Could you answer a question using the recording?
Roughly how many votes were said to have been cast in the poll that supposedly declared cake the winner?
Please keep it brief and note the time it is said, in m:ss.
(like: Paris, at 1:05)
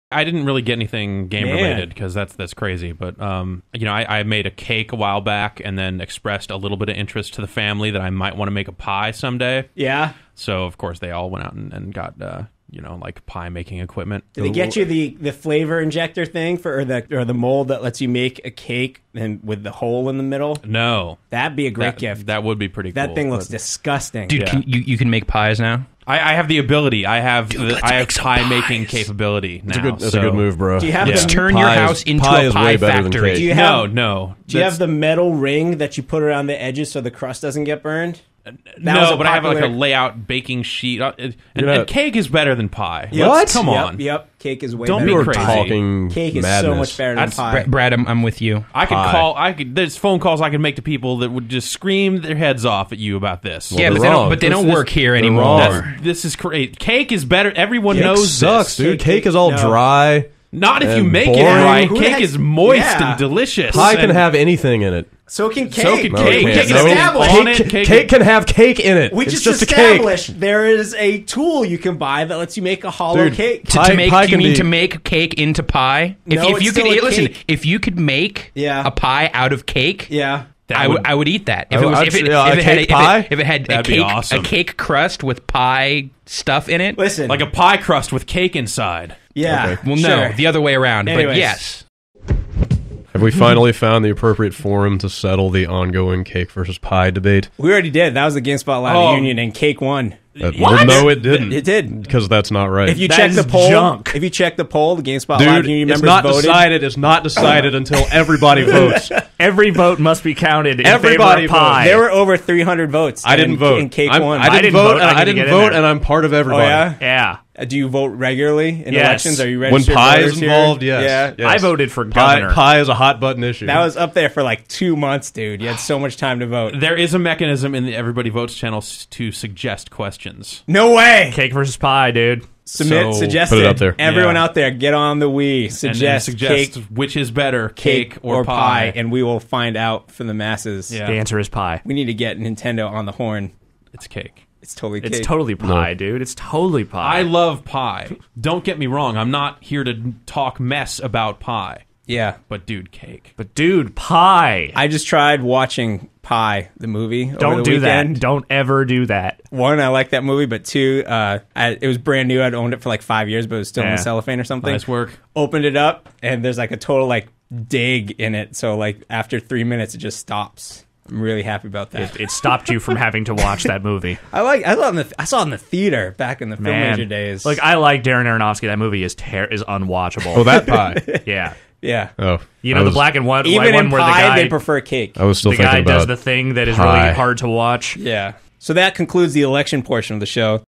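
over 300, at 1:52.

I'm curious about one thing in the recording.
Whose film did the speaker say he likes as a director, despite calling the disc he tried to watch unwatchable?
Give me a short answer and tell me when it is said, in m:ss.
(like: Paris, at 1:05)
Darren Aronofsky, at 2:58.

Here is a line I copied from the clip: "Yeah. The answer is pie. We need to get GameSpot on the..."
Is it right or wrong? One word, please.
wrong.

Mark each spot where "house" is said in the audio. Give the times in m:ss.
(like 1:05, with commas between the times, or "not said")
0:31.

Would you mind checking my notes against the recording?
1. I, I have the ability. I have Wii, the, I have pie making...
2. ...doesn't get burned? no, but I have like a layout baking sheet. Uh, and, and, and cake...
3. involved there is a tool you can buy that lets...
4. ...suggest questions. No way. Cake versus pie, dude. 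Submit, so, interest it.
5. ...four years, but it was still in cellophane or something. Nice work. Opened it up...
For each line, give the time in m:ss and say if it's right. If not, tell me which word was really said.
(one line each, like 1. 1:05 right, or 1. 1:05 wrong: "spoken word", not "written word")
1. 0:26 wrong: "Dude", not "Wii"
2. 0:37 right
3. 1:09 wrong: "established", not "involved"
4. 2:09 wrong: "suggest", not "interest"
5. 2:43 wrong: "five", not "four".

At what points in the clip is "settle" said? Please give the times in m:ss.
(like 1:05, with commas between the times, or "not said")
1:35.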